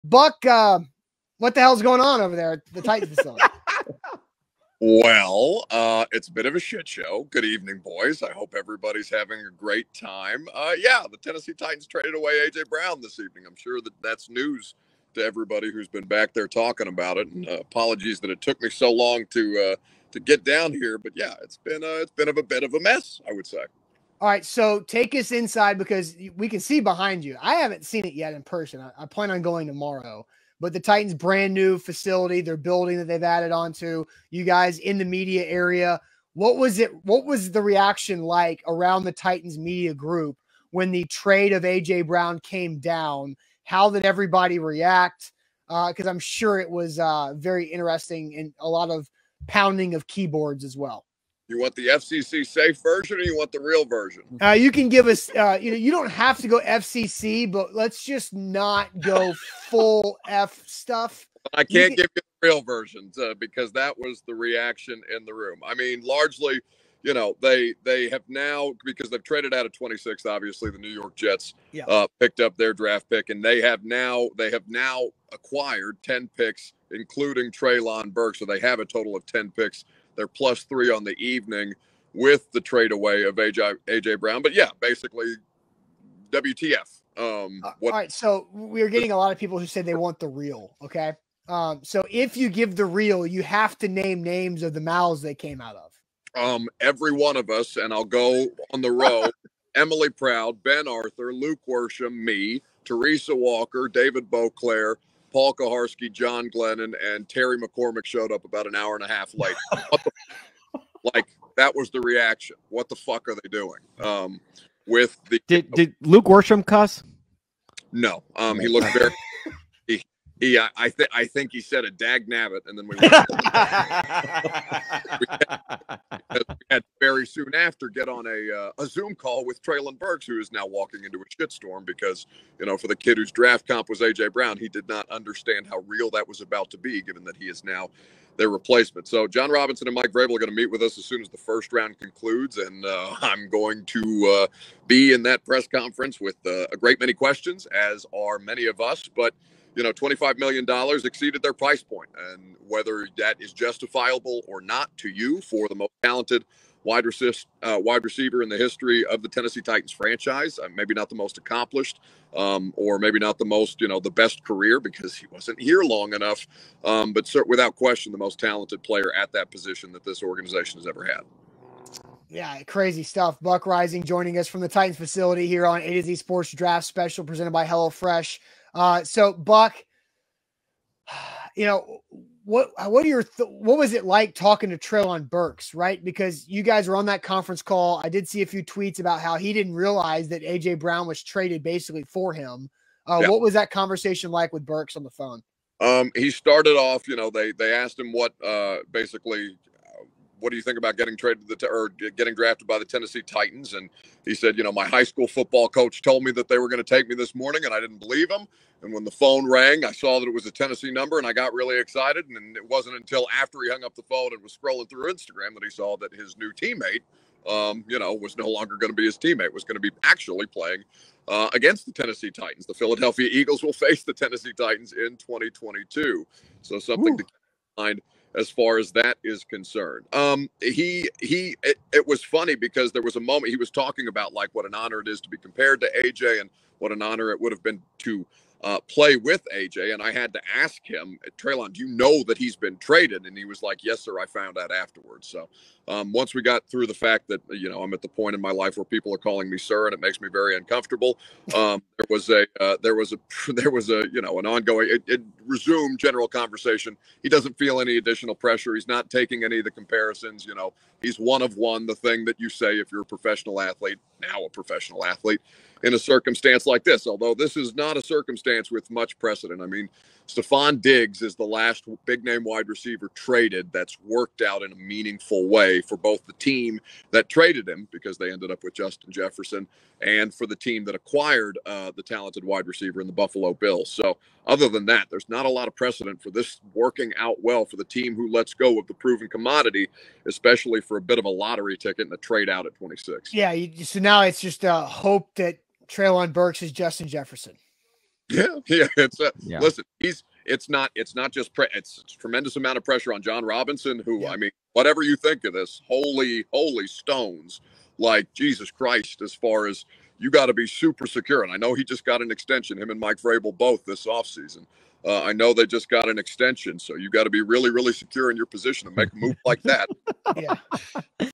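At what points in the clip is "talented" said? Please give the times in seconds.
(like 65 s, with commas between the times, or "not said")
156 s, 168 s, 282 s.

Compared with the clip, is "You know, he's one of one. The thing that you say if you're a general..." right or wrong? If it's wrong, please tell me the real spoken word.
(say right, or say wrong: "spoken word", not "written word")
wrong: "professional", not "general".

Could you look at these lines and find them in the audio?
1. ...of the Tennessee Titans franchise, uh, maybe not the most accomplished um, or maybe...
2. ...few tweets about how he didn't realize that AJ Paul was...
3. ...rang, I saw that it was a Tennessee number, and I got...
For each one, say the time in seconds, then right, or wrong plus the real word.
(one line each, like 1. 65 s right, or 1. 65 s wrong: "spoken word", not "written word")
1. 159 s right
2. 188 s wrong: "Brown", not "Paul"
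3. 209 s right.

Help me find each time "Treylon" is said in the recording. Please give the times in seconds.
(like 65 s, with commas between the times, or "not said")
77 s, 129 s, 184 s, 241 s, 295 s.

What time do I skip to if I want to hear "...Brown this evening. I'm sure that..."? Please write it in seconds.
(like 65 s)
12 s.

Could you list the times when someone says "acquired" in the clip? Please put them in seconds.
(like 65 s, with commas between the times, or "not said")
75 s, 280 s.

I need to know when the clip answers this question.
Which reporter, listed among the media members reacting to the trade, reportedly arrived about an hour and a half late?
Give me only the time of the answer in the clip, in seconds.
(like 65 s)
107 s.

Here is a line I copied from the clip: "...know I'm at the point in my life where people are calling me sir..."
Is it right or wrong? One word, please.
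right.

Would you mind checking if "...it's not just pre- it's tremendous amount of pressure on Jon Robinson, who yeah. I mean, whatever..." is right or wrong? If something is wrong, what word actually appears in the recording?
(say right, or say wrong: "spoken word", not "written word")
right.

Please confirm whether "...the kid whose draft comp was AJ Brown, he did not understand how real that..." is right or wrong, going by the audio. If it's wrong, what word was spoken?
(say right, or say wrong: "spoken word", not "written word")
right.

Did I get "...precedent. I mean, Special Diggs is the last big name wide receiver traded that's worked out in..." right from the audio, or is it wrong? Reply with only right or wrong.
wrong.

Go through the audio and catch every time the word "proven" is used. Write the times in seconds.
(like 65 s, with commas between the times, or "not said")
288 s.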